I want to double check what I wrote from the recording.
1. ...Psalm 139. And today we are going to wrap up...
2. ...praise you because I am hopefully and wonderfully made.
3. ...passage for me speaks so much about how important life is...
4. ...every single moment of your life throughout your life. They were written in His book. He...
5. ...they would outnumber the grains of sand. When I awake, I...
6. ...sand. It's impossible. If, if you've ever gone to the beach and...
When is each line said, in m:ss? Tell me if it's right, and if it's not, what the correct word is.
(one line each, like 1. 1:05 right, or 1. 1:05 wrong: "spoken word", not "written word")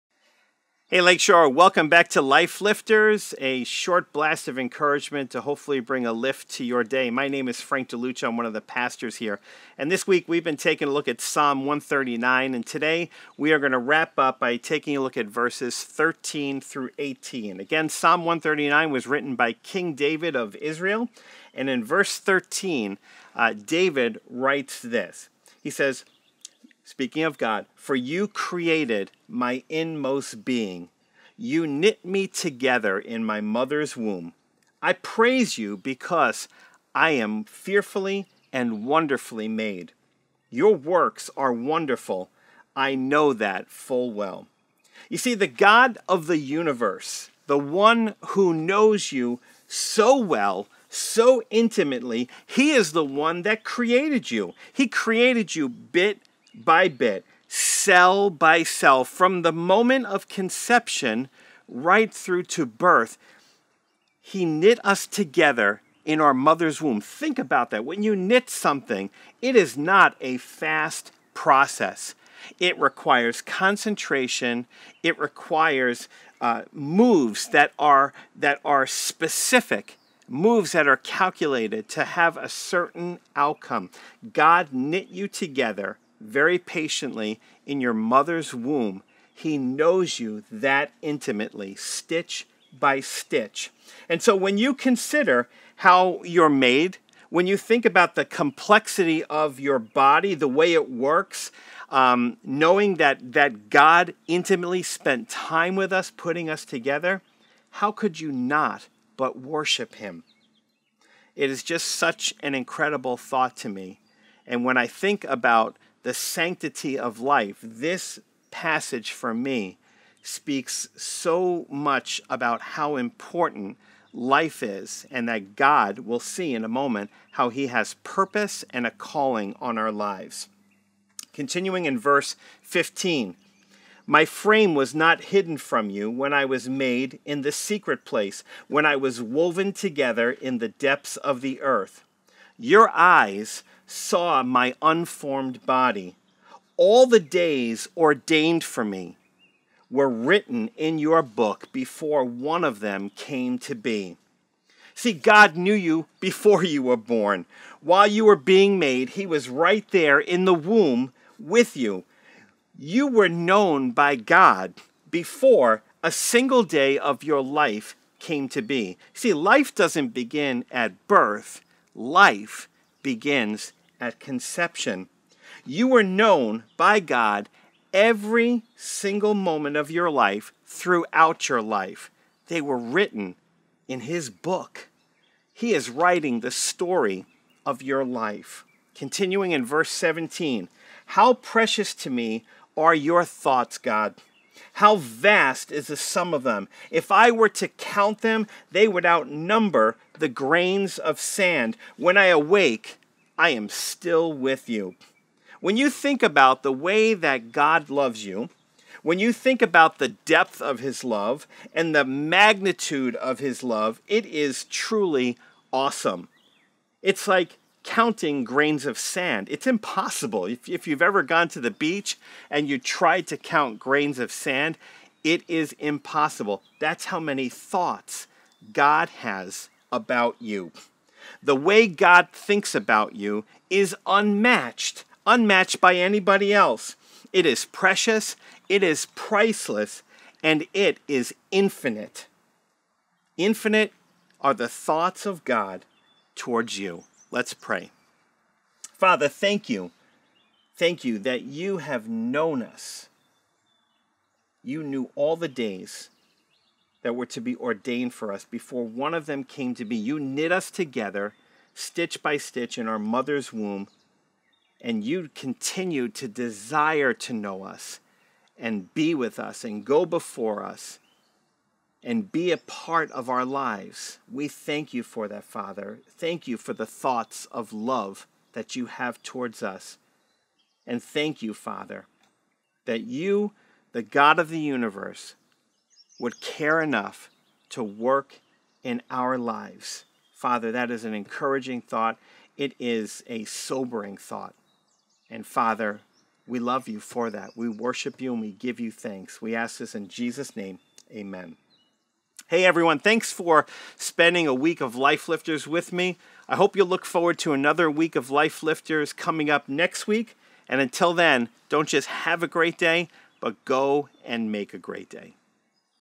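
1. 0:11 right
2. 0:34 wrong: "fearfully", not "hopefully"
3. 1:58 right
4. 2:57 right
5. 3:18 right
6. 3:38 right.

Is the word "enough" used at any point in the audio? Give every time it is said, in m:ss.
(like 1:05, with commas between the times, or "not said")
4:46.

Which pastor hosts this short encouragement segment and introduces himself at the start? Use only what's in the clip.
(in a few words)
Frank De Luccio.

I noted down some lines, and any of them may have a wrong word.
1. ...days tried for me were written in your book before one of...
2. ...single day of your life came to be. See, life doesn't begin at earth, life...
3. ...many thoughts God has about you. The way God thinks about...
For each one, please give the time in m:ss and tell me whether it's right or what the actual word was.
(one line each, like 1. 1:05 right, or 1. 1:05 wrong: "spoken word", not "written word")
1. 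2:27 wrong: "ordained", not "tried"
2. 2:46 wrong: "birth", not "earth"
3. 3:47 right.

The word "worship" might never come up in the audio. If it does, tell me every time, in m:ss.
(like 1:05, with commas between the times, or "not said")
1:49, 4:57.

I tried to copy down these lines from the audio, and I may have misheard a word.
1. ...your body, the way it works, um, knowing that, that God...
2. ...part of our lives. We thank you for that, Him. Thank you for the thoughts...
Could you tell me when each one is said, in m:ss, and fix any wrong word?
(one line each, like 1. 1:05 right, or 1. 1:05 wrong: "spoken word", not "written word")
1. 1:39 right
2. 4:32 wrong: "Father", not "Him".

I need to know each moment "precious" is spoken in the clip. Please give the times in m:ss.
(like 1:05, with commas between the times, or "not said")
3:11, 3:57.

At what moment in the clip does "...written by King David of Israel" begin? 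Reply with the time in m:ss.
0:19.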